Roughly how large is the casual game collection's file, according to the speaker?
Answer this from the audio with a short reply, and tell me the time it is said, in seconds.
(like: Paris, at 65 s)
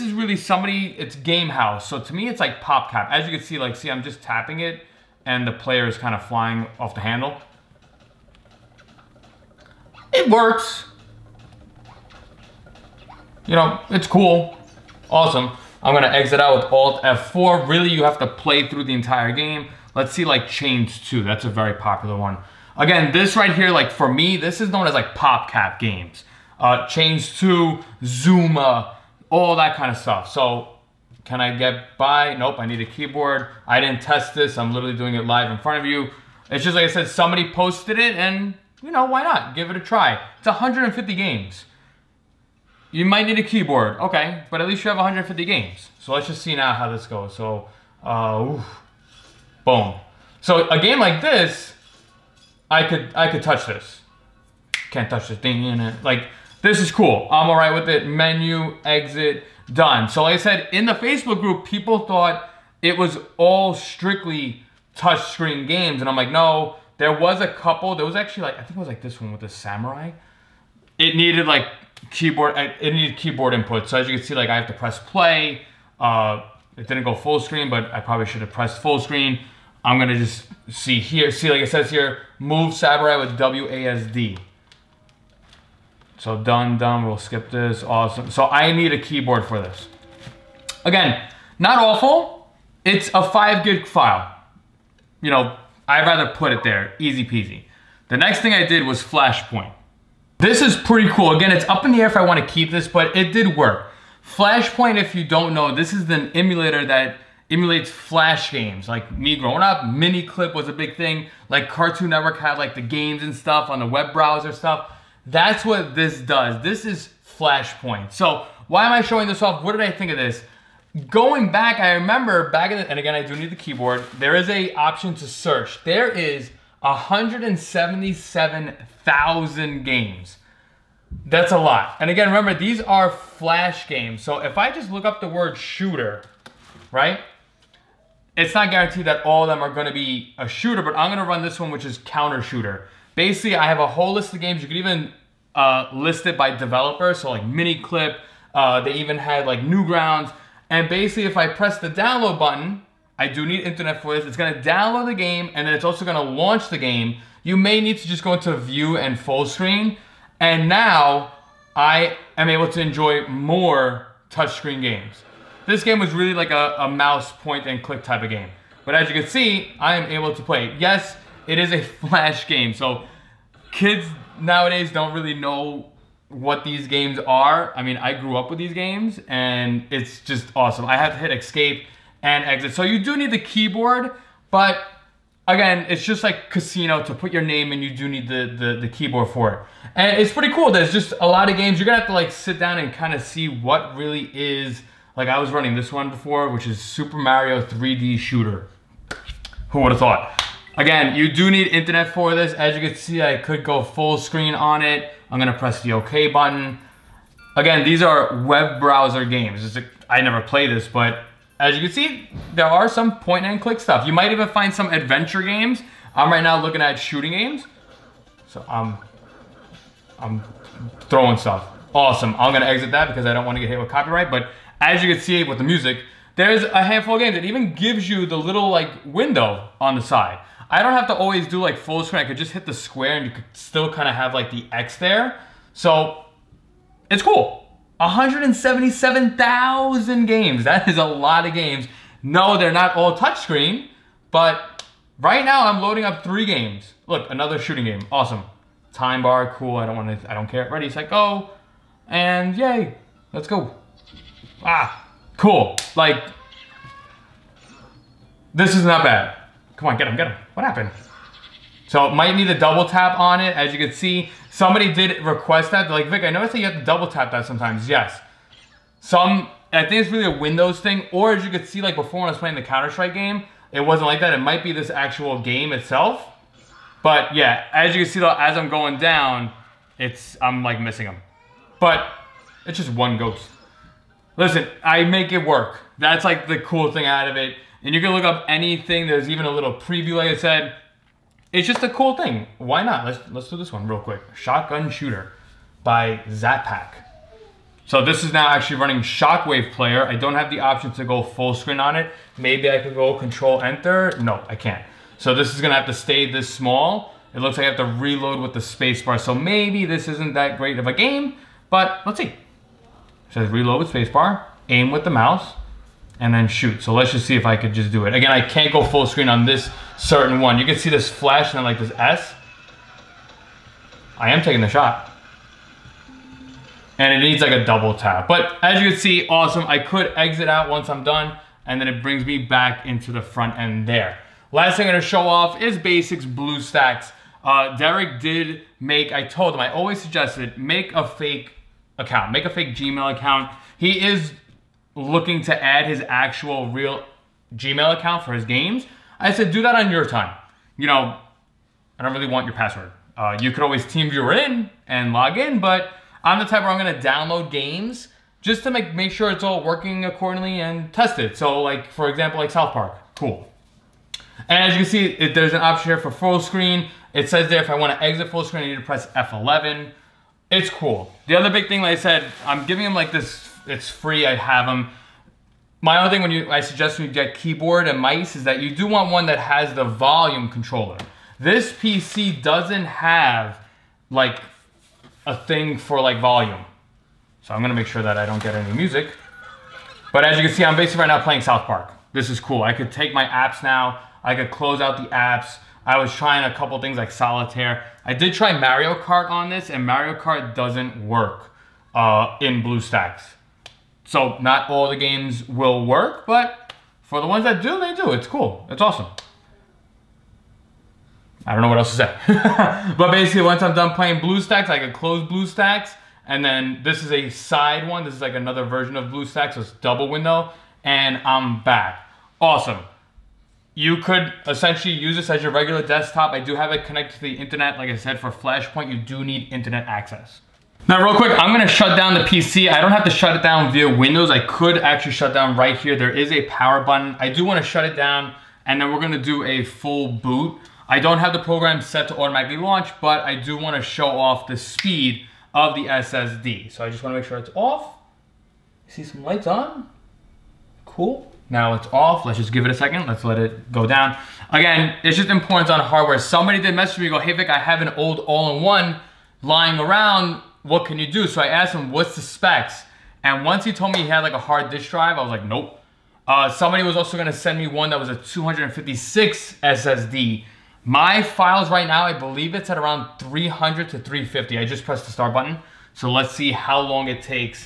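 5 gig, at 93 s.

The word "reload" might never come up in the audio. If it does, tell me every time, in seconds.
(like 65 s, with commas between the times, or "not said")
308 s, 313 s.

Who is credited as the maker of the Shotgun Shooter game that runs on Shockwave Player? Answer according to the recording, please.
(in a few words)
Zatpak.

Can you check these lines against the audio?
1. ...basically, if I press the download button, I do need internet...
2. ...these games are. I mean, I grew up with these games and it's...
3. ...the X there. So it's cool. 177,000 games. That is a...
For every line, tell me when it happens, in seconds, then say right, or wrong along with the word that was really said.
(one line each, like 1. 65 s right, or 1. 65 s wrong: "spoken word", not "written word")
1. 150 s right
2. 176 s right
3. 234 s right.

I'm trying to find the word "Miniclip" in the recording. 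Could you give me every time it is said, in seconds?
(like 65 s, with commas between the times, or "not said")
109 s, 147 s.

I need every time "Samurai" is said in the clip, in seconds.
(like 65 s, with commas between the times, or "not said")
69 s, 82 s.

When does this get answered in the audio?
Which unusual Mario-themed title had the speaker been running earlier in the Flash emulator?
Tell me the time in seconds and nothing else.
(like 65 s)
196 s.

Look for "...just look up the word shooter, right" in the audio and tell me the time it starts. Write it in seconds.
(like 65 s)
134 s.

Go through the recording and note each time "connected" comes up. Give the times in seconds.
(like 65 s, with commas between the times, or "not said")
426 s.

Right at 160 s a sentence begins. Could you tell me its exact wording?
And now I am able to enjoy more touchscreen games.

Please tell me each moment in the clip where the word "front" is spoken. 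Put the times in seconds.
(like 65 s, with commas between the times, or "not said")
35 s, 333 s.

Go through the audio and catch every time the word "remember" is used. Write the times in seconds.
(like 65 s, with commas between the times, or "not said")
121 s, 132 s.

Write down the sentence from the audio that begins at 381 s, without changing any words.
This PC doesn't have like a thing for like volume.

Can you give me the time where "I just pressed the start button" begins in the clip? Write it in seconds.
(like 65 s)
474 s.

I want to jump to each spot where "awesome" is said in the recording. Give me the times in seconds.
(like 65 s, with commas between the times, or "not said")
15 s, 87 s, 180 s, 221 s, 248 s, 329 s, 408 s, 422 s.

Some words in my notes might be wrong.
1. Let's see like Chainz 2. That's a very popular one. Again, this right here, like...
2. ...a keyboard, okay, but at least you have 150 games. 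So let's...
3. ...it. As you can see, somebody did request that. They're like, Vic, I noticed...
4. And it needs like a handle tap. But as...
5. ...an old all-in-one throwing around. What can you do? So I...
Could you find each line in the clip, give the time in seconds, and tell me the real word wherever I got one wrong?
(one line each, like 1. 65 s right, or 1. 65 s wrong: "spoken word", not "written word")
1. 19 s right
2. 43 s right
3. 263 s right
4. 326 s wrong: "double", not "handle"
5. 457 s wrong: "lying", not "throwing".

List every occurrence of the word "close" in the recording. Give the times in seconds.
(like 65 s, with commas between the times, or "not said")
394 s, 414 s.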